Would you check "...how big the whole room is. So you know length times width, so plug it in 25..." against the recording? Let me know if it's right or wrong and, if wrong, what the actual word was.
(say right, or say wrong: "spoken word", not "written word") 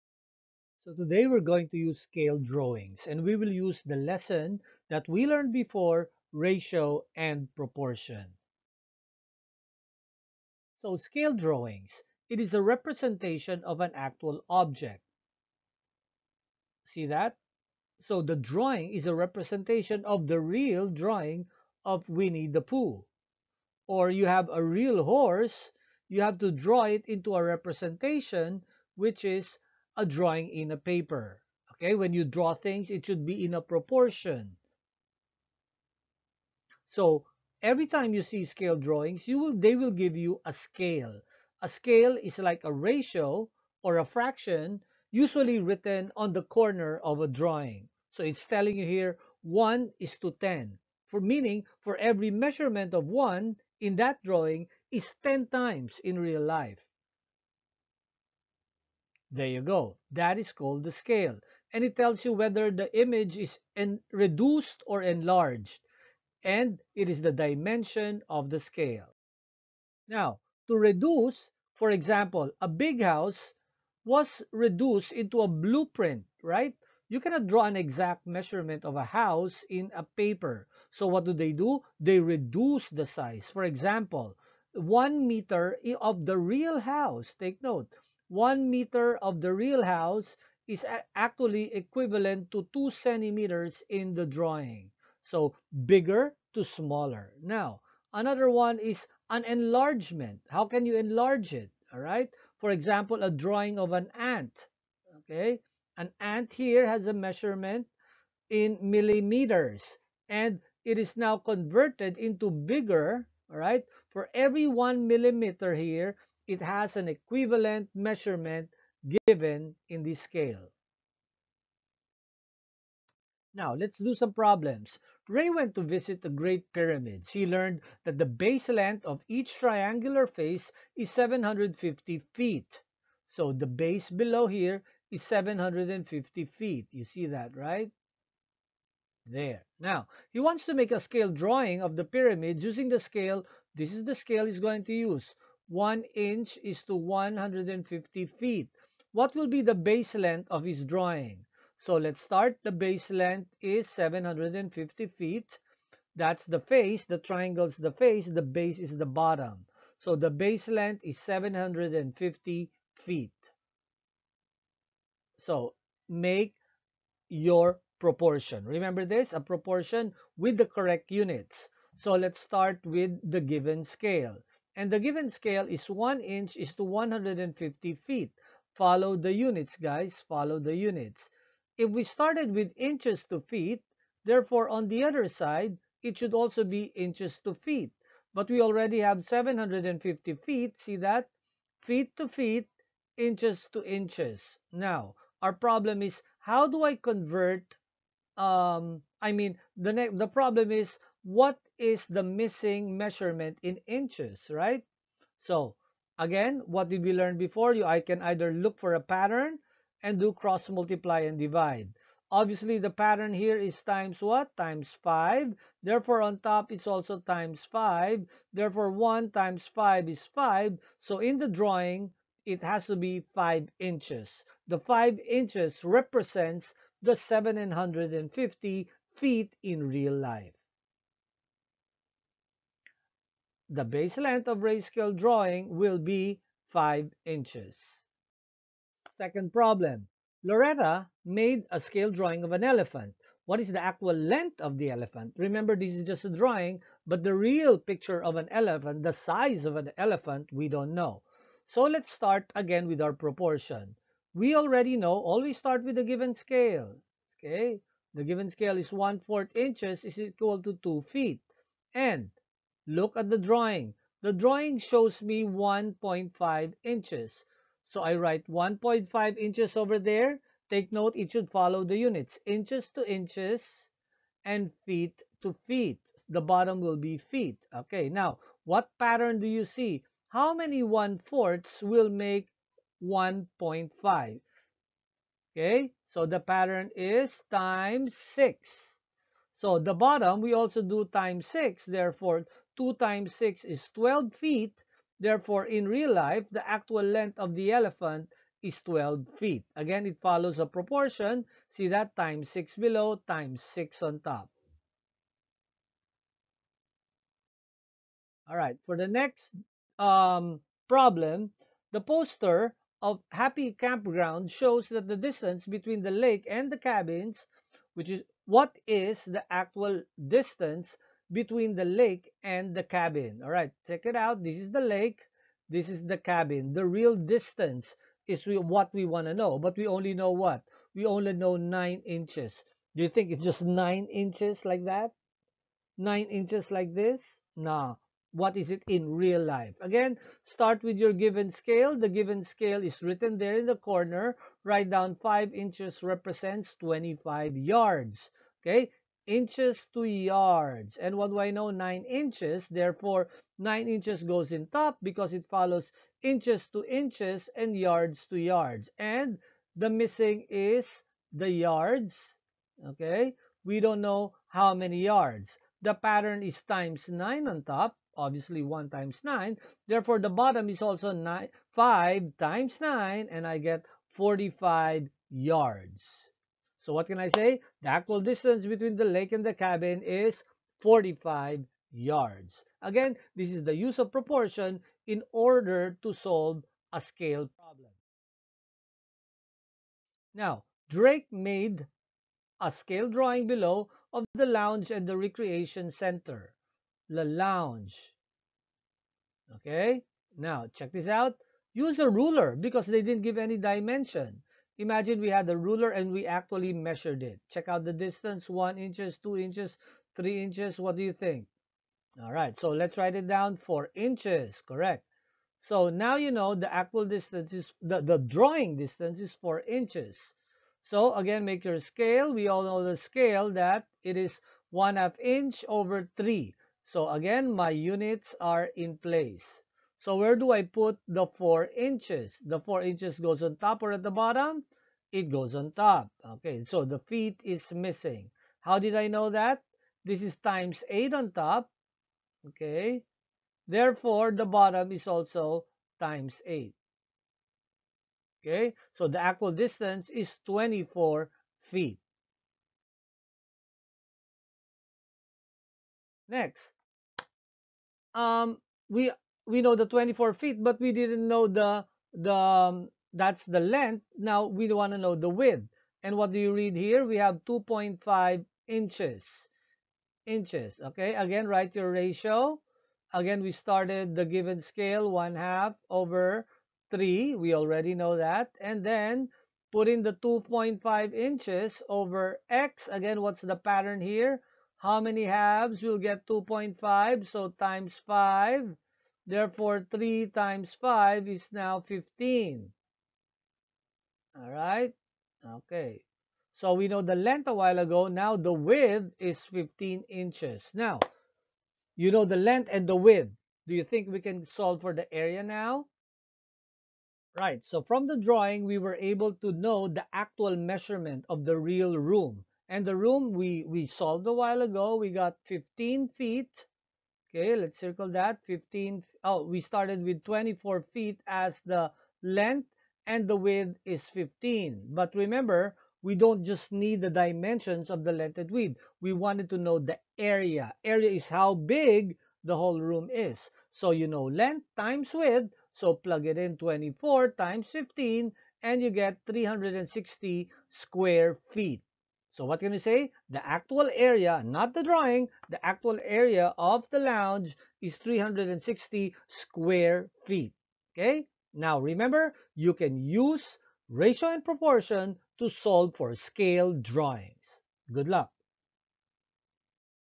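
wrong: "24", not "25".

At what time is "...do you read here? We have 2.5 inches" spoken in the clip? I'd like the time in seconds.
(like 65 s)
466 s.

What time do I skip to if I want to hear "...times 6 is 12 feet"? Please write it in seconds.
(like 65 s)
292 s.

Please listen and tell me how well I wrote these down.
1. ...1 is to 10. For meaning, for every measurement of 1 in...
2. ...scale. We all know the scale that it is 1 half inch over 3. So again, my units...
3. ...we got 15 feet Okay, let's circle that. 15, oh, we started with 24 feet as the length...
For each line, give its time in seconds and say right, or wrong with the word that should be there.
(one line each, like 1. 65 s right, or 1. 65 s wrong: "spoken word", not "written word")
1. 49 s right
2. 421 s right
3. 514 s right.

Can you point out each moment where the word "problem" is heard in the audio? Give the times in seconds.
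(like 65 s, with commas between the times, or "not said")
124 s, 195 s, 200 s, 239 s, 310 s, 387 s.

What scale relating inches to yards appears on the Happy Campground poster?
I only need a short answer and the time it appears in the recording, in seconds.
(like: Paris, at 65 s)
5 inches to 25 yards, at 345 s.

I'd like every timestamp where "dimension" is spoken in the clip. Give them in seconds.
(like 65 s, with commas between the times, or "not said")
67 s, 403 s, 527 s.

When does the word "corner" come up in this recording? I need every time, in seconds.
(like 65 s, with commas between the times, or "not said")
46 s, 343 s.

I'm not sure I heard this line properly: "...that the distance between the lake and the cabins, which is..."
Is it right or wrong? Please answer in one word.
right.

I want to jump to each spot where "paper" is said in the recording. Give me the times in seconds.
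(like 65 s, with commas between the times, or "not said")
30 s, 80 s.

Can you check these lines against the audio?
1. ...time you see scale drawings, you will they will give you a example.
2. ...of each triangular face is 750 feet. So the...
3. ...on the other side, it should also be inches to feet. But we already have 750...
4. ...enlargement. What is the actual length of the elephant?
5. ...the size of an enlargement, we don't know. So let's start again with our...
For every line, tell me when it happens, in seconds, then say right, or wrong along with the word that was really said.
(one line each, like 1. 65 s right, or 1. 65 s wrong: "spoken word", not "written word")
1. 37 s wrong: "scale", not "example"
2. 129 s right
3. 184 s right
4. 242 s wrong: "elephant", not "enlargement"
5. 249 s wrong: "elephant", not "enlargement".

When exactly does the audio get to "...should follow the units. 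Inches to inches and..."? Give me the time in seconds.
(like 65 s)
271 s.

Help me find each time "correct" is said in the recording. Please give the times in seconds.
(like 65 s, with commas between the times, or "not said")
170 s, 414 s.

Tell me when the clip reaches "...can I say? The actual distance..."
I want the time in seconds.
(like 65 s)
377 s.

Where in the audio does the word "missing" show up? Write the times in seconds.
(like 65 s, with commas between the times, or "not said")
202 s, 359 s, 437 s.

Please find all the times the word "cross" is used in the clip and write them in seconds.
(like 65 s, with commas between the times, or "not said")
210 s.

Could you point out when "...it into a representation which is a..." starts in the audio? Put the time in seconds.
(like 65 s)
26 s.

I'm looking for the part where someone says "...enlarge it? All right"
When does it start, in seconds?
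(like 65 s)
100 s.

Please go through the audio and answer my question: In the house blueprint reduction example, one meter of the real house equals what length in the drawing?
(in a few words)
2 centimeters.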